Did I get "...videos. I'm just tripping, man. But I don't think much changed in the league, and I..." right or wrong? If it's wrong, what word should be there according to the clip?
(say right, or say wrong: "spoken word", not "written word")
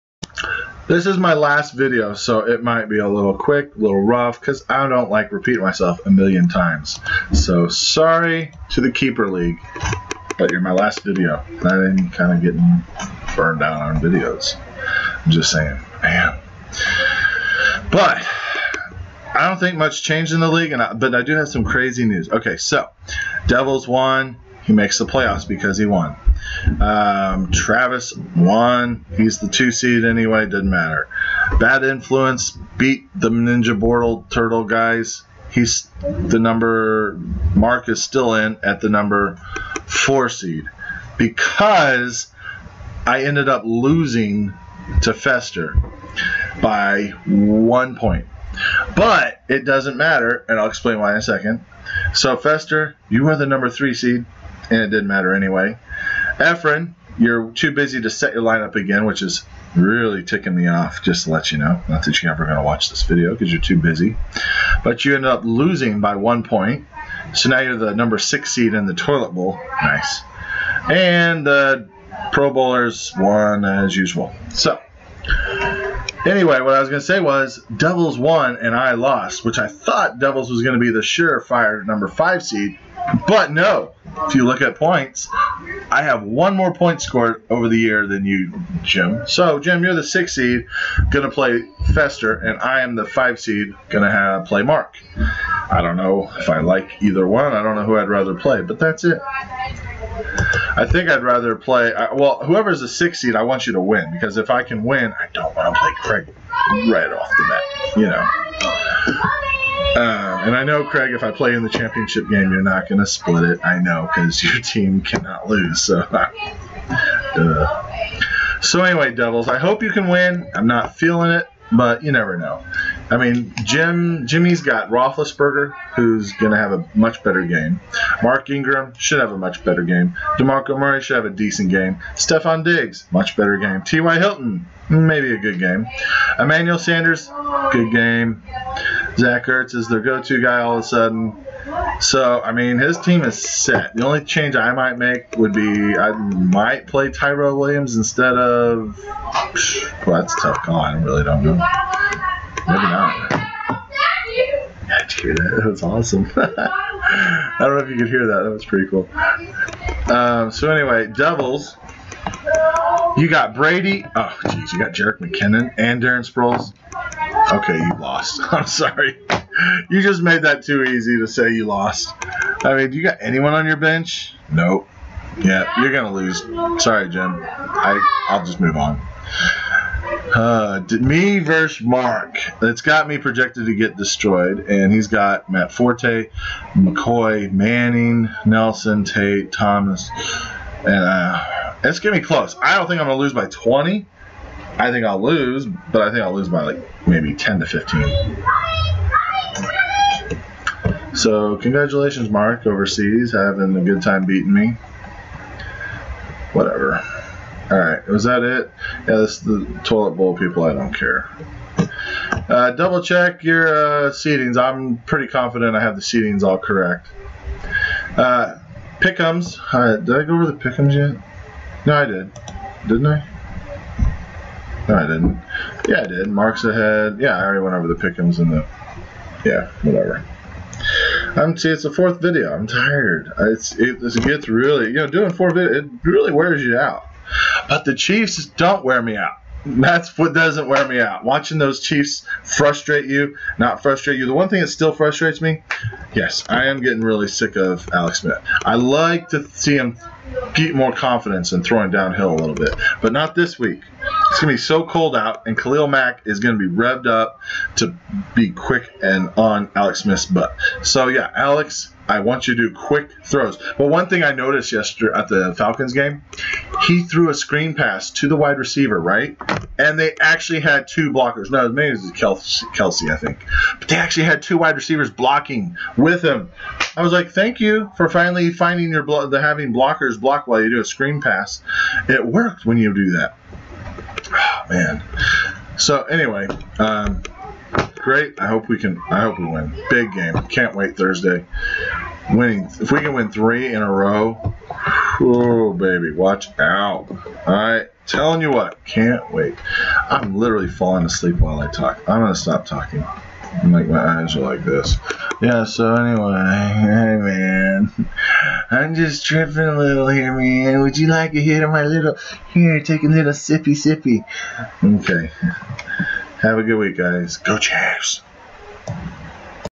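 wrong: "saying", not "tripping".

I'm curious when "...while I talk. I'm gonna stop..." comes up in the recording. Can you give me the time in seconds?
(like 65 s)
301 s.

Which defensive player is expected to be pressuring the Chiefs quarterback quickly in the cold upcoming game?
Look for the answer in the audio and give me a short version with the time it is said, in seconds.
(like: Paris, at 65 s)
Khalil Mack, at 255 s.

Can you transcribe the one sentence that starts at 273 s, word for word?
But they actually had two wide receivers blocking with him.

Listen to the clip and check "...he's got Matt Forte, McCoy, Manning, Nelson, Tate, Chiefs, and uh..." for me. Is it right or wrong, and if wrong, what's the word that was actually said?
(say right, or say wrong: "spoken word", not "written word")
wrong: "Thomas", not "Chiefs".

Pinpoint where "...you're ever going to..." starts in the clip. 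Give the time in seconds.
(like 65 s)
62 s.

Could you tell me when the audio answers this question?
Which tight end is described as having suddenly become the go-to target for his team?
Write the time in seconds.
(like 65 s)
139 s.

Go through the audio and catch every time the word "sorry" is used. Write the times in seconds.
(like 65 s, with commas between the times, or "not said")
7 s, 168 s, 176 s.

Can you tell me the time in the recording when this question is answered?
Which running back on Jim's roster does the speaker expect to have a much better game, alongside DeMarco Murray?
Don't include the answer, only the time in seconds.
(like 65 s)
128 s.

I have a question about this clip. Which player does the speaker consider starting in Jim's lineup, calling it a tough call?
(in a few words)
Tyro Williams.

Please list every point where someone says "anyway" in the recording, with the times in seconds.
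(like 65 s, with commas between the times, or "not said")
30 s, 55 s, 76 s, 118 s, 160 s, 286 s, 305 s.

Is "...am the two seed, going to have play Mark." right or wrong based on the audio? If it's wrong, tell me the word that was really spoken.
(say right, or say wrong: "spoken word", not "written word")
wrong: "five", not "two".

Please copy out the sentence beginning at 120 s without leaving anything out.
I'm not feeling it, but you never know.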